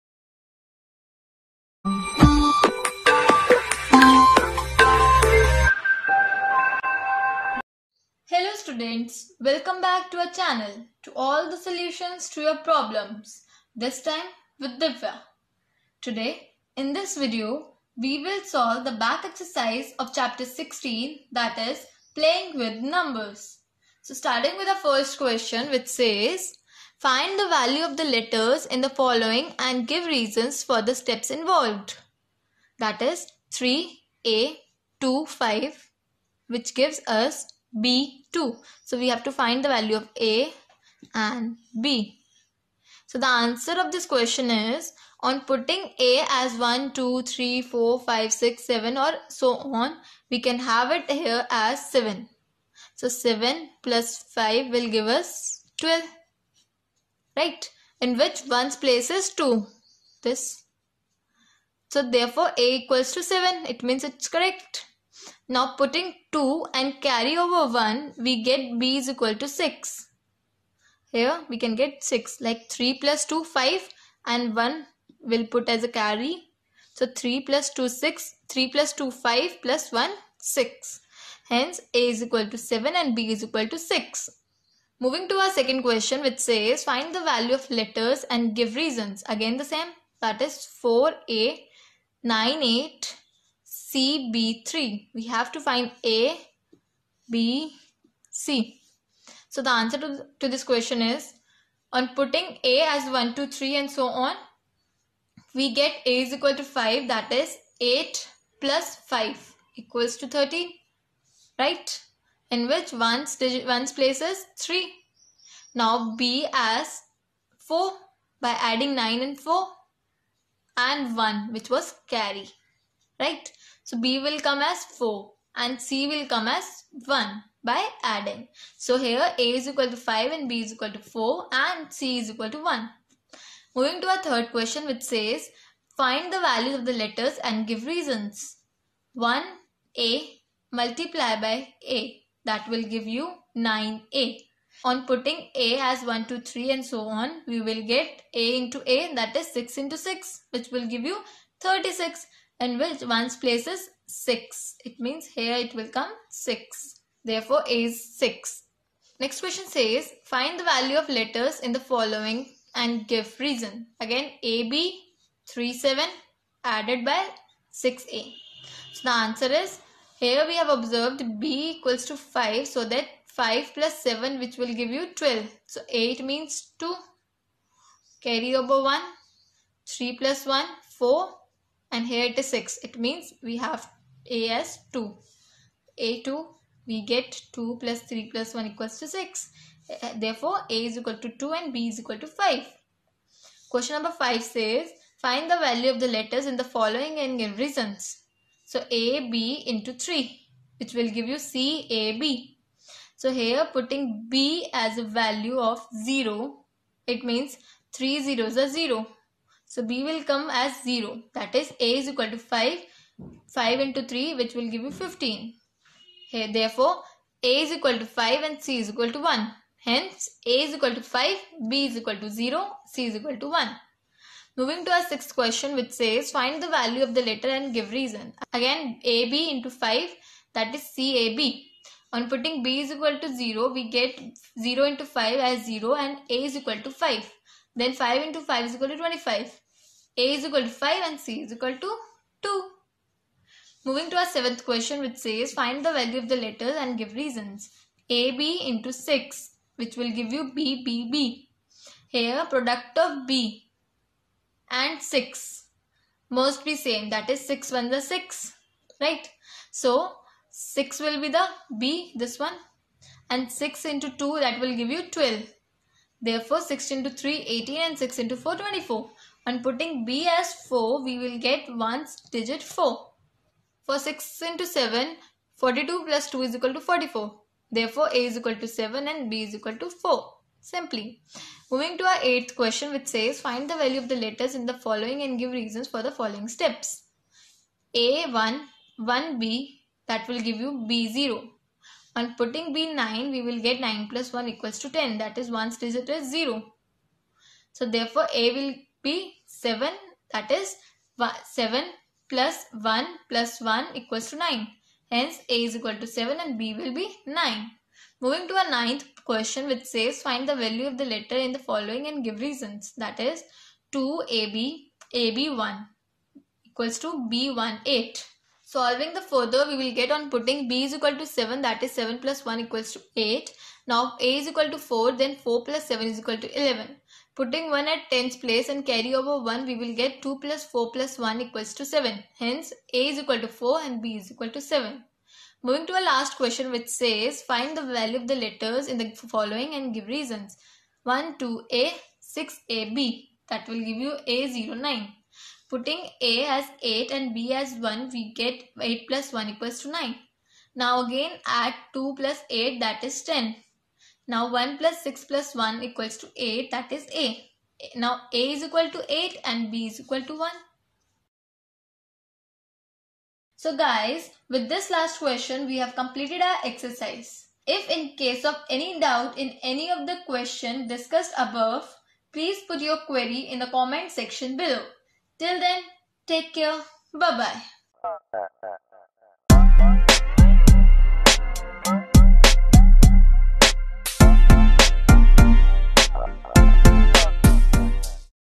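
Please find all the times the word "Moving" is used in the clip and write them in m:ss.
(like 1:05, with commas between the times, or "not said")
1:24, 2:13, 3:44, 4:03, 4:41, 5:08, 5:35.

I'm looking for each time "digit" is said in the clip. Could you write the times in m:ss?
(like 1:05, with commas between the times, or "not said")
1:53, 4:32, 4:55.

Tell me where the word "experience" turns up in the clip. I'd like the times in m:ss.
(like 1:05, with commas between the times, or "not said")
not said.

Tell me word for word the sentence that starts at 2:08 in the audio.
So here A is equal to 5 and B is equal to 4 and C is equal to 1.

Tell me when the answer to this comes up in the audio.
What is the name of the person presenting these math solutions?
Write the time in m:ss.
0:14.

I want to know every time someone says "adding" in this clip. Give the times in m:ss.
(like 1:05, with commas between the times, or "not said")
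1:58, 2:08.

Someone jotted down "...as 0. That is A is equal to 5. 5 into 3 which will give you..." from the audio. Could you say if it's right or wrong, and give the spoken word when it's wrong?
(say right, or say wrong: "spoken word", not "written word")
right.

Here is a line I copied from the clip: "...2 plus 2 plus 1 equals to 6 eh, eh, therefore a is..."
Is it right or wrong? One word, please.
wrong.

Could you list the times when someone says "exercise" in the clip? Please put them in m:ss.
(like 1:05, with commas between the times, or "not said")
0:19, 6:06.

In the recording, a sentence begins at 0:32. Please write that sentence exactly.
That is 3, A, 2, 5 which gives us B2.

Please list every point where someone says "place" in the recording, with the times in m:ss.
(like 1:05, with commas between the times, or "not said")
0:58, 1:53, 2:33, 5:28.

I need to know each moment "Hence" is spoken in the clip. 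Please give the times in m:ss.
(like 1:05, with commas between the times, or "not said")
1:21, 3:39, 5:05, 5:32.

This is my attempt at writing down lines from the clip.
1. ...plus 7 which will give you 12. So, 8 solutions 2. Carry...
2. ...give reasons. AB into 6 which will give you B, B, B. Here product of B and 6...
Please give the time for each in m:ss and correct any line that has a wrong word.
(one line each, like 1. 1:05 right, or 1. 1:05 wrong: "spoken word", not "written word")
1. 2:53 wrong: "means", not "solutions"
2. 4:06 right.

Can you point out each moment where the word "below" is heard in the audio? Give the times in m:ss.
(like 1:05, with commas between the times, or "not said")
6:14.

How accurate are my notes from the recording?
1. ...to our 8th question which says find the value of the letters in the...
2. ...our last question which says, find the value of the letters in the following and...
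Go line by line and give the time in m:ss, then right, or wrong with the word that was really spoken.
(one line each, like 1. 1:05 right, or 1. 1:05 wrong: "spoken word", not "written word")
1. 4:41 right
2. 5:35 right.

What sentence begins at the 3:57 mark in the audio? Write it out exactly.
Then 5 into 5 is equal to 25 a is equal to 5 and c is equal to 2.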